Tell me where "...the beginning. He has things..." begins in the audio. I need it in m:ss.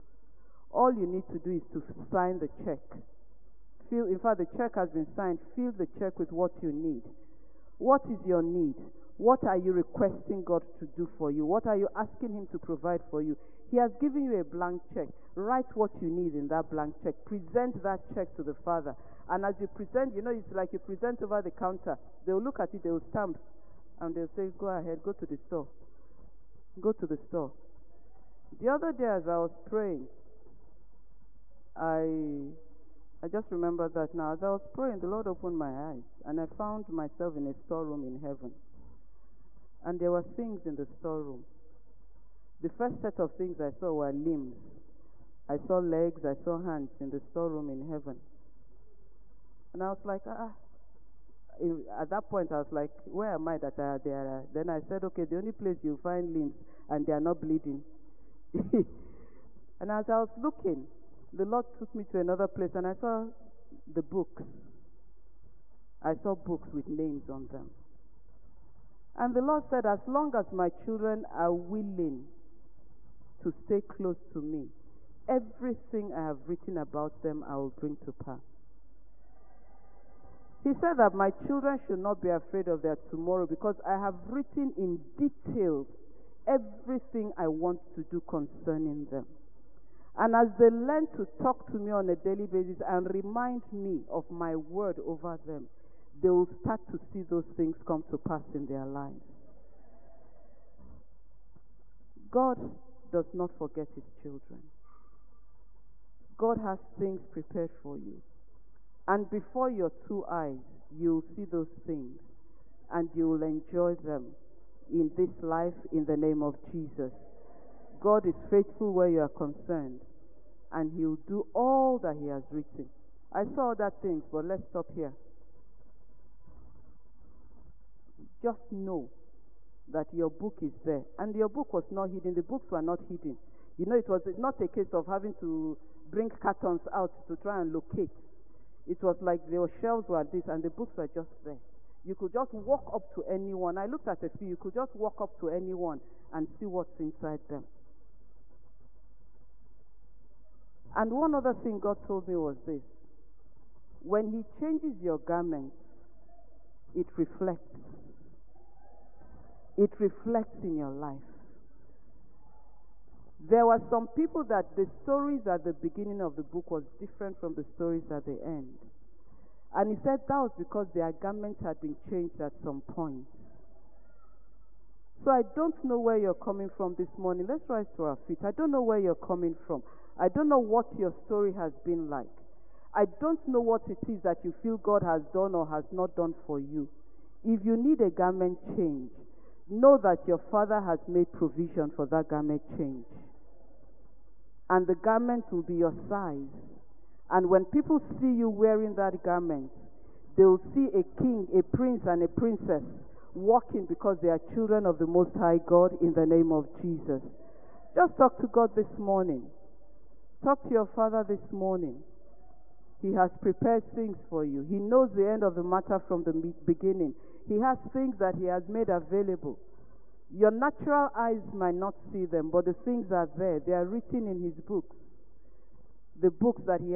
3:36.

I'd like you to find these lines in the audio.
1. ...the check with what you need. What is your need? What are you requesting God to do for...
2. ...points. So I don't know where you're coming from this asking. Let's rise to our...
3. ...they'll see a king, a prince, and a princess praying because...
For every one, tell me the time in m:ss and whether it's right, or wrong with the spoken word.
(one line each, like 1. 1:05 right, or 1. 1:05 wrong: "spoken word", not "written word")
1. 0:05 right
2. 2:52 wrong: "morning", not "asking"
3. 3:20 wrong: "walking", not "praying".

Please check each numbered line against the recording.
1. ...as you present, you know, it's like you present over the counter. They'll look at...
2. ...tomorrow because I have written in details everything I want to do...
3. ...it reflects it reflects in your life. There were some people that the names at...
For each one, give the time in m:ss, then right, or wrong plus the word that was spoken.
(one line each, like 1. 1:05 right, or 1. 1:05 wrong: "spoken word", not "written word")
1. 0:19 right
2. 1:22 right
3. 2:36 wrong: "stories", not "names".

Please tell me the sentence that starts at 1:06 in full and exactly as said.
I saw books with names on them.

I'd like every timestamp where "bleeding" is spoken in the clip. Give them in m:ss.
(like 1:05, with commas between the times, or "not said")
0:57.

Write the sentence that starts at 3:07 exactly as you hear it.
If you need a garment change, Know that your father has made provision for that garment change.